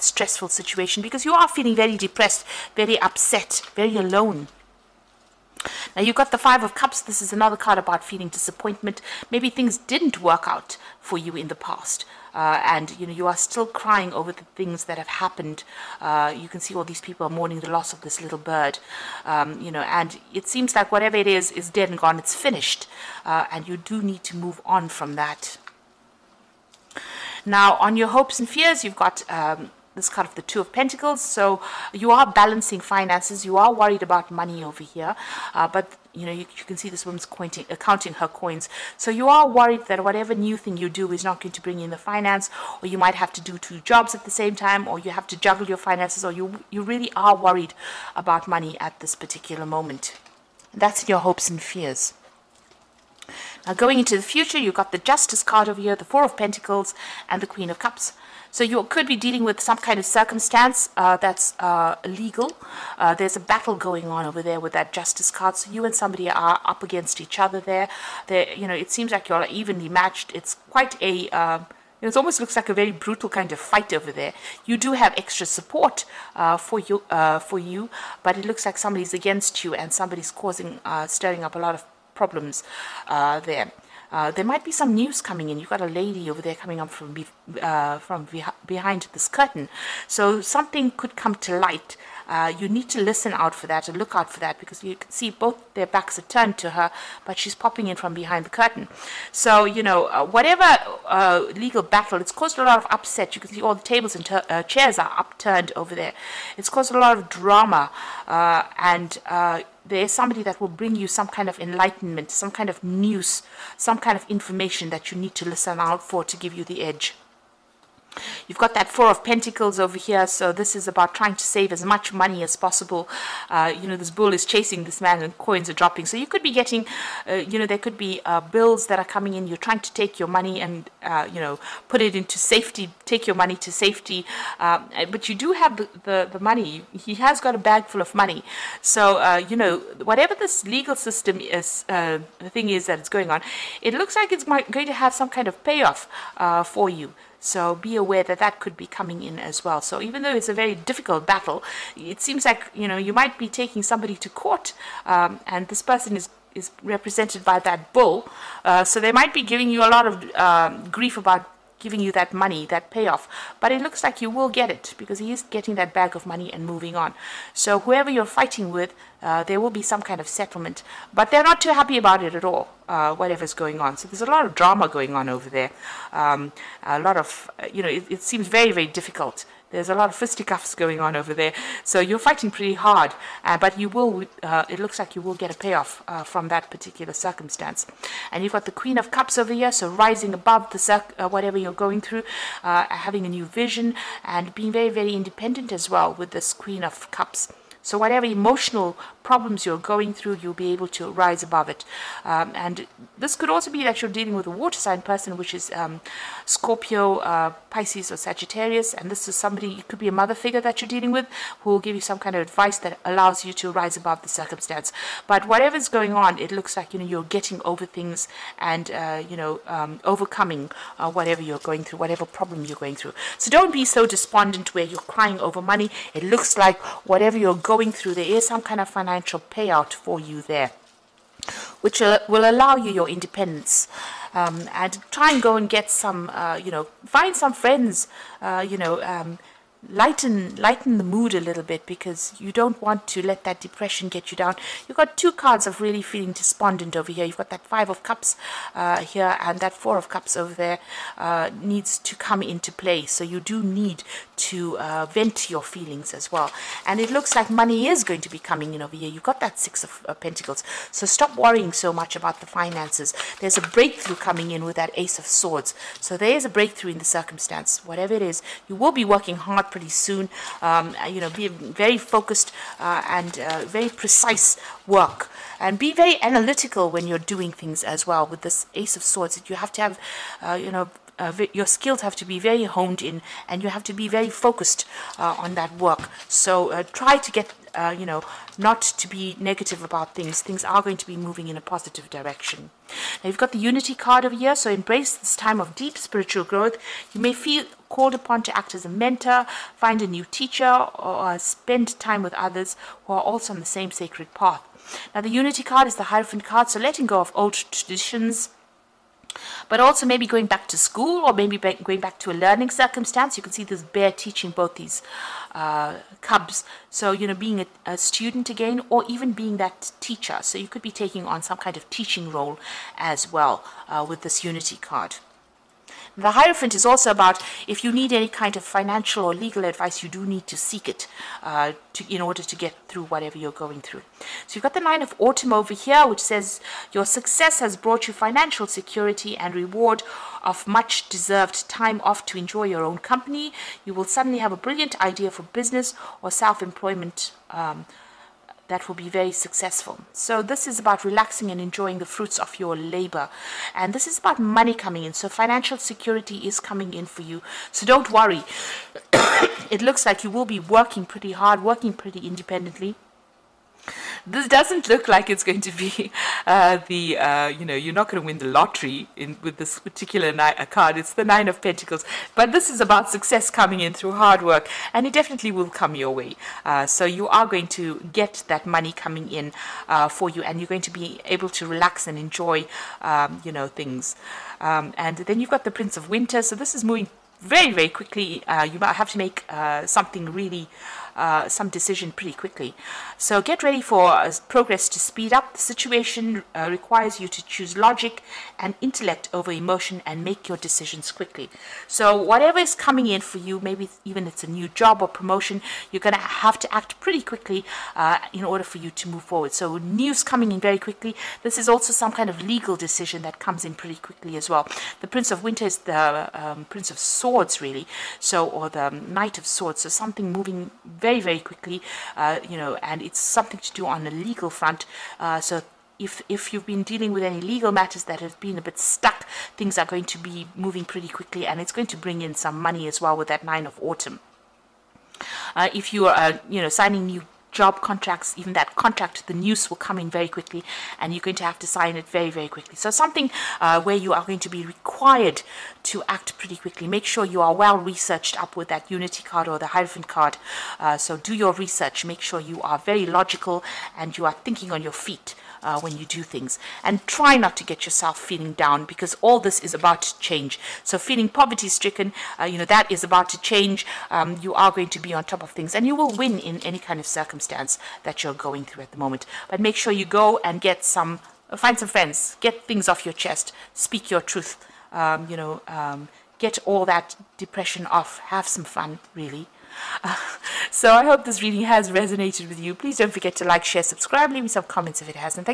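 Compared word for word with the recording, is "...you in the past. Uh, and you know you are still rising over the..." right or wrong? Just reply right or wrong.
wrong.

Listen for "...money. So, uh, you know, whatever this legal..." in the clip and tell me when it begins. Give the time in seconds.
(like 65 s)
138 s.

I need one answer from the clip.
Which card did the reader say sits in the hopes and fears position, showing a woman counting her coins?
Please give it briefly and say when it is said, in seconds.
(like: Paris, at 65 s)
Two of Pentacles, at 30 s.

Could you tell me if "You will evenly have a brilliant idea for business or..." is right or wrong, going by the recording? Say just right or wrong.
wrong.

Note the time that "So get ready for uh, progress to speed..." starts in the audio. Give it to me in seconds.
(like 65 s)
393 s.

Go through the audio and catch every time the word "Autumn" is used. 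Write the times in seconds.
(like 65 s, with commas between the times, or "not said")
335 s, 433 s.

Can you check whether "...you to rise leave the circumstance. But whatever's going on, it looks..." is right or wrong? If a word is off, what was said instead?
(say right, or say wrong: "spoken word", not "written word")
wrong: "above", not "leave".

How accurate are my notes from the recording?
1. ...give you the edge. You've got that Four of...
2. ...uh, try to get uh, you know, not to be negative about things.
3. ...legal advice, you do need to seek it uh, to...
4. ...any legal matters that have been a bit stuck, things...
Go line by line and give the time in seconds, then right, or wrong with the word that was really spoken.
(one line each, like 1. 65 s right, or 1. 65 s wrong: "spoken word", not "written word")
1. 116 s right
2. 286 s right
3. 329 s right
4. 427 s right.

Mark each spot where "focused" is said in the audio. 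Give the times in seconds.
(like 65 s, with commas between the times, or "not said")
271 s, 284 s.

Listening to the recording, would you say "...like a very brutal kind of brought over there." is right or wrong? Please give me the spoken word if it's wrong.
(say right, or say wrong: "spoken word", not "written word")
wrong: "fight", not "brought".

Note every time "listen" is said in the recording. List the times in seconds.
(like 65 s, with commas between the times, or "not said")
93 s, 115 s.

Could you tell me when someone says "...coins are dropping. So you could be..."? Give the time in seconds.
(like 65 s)
125 s.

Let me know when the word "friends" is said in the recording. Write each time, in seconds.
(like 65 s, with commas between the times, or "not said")
237 s, 471 s.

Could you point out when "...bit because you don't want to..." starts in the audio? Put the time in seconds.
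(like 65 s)
241 s.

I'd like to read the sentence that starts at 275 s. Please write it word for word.
And be very analytical when you're doing things as well.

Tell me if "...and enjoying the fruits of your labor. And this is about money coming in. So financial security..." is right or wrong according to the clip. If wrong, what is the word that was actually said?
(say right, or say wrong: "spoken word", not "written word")
right.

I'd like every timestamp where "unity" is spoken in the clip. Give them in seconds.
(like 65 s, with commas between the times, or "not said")
293 s, 305 s, 324 s, 448 s.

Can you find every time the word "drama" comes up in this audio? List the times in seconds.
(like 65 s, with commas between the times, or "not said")
107 s, 174 s.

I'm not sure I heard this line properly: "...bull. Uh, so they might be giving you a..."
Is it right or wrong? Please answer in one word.
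right.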